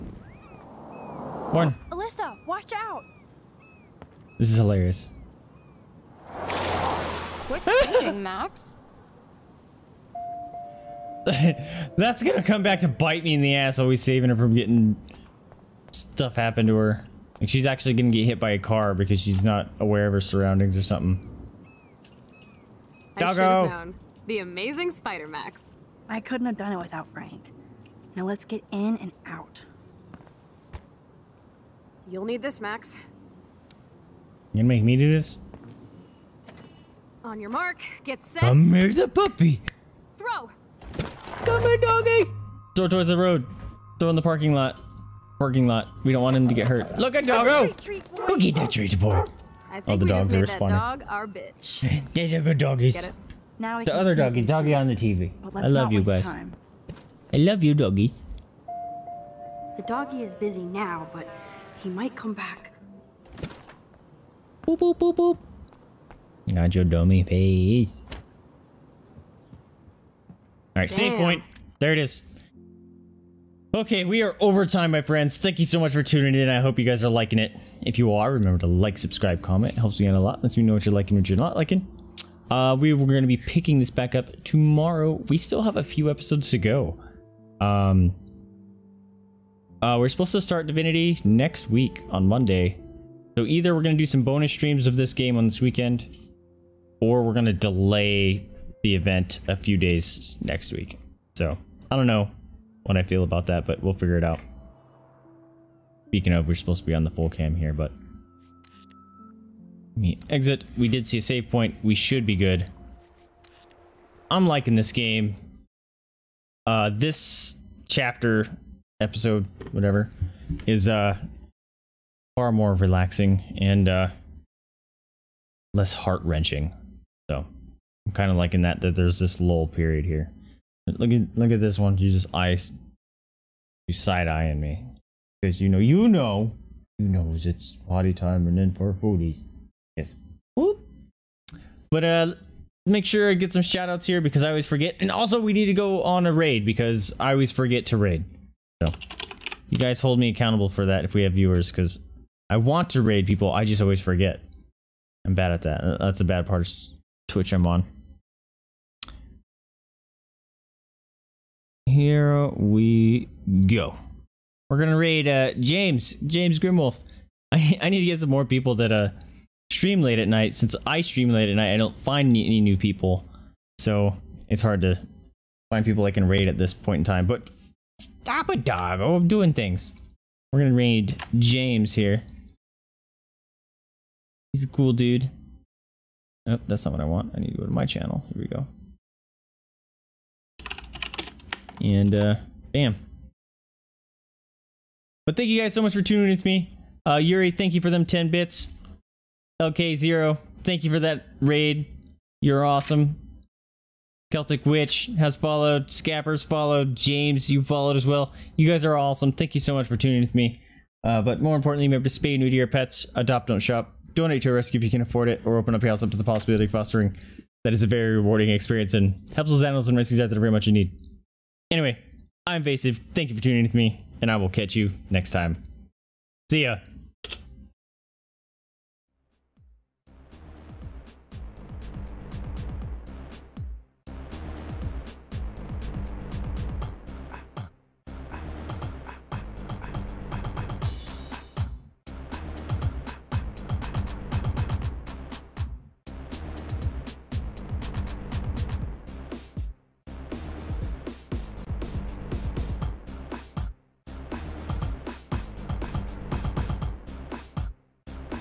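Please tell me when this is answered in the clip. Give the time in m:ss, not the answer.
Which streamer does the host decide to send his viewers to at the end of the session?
2:46.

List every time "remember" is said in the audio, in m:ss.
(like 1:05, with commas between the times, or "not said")
1:18, 3:31.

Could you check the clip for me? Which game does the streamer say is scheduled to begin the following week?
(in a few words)
Divinity.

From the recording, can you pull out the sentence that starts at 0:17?
Like she's actually gonna get hit by a car because she's not aware of her surroundings or something.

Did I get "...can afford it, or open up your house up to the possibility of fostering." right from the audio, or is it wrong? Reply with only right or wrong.
right.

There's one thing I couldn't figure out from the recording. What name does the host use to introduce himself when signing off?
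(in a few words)
Vaesive.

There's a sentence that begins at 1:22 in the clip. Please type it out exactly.
Uh, we were going to be picking this back up tomorrow.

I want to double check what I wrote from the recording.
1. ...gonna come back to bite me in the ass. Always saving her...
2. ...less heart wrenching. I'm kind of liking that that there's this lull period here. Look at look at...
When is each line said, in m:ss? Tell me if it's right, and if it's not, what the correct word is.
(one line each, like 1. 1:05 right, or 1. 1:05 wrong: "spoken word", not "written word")
1. 0:12 right
2. 2:05 right.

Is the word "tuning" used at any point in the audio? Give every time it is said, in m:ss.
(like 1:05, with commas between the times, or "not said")
1:16, 3:16, 3:29, 3:43.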